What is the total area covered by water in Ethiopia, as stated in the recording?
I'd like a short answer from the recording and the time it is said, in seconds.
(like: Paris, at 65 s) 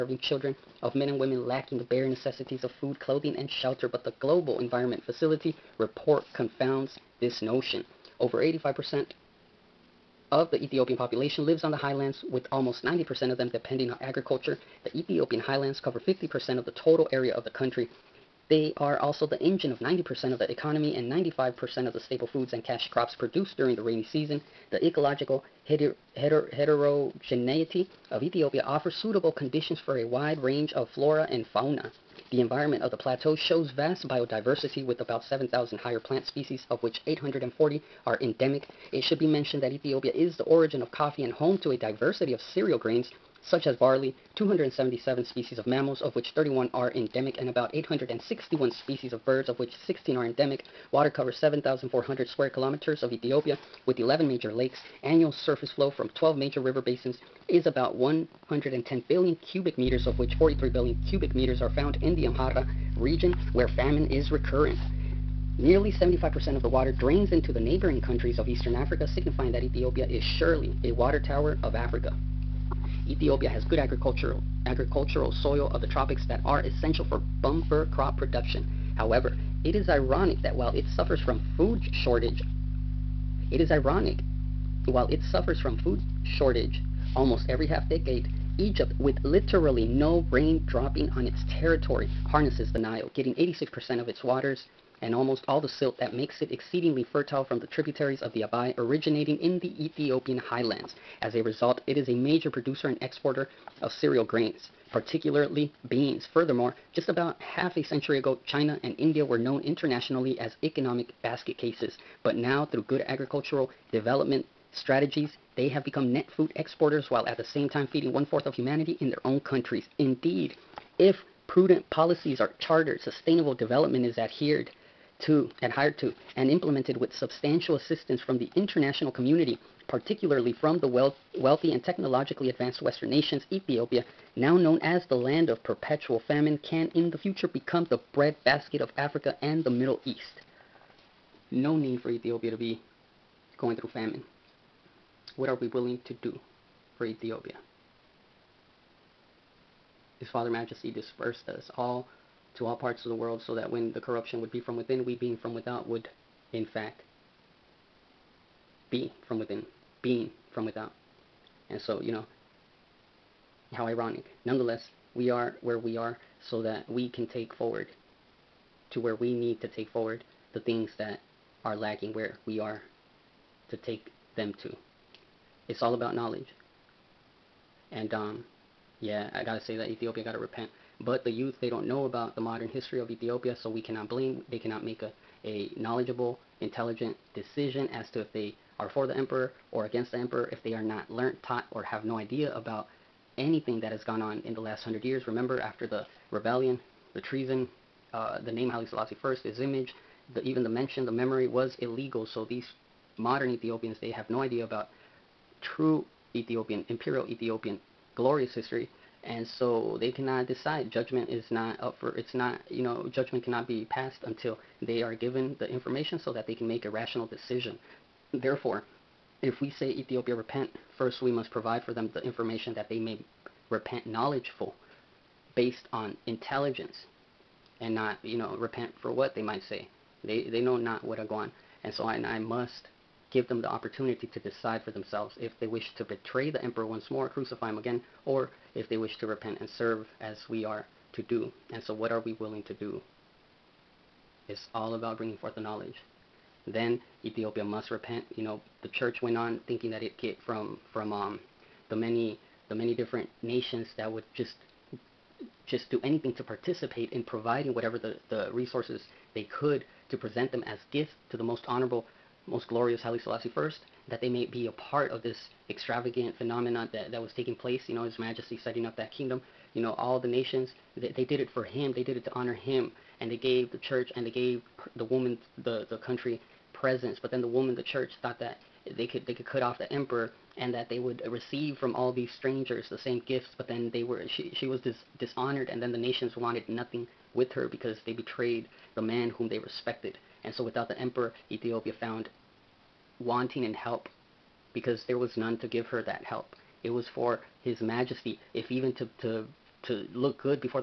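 7,400 square kilometers, at 51 s.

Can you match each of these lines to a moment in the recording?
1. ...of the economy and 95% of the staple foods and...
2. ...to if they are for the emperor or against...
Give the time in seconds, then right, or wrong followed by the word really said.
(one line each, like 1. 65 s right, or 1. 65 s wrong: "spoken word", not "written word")
1. 20 s right
2. 188 s right.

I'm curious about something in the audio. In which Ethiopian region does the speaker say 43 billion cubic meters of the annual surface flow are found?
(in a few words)
Amhara.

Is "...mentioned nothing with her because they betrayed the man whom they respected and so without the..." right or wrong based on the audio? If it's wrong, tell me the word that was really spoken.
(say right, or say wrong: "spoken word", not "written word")
wrong: "wanted", not "mentioned".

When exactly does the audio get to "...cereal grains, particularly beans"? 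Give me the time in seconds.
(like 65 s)
103 s.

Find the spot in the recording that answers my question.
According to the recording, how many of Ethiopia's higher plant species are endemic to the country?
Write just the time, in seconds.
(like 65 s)
37 s.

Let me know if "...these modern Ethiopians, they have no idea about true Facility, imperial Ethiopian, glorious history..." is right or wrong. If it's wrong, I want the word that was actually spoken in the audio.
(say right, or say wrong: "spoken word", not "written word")
wrong: "Ethiopian", not "Facility".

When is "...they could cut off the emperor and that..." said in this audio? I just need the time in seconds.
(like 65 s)
279 s.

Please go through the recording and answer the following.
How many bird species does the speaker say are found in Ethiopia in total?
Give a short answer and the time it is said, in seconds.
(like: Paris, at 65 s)
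861, at 47 s.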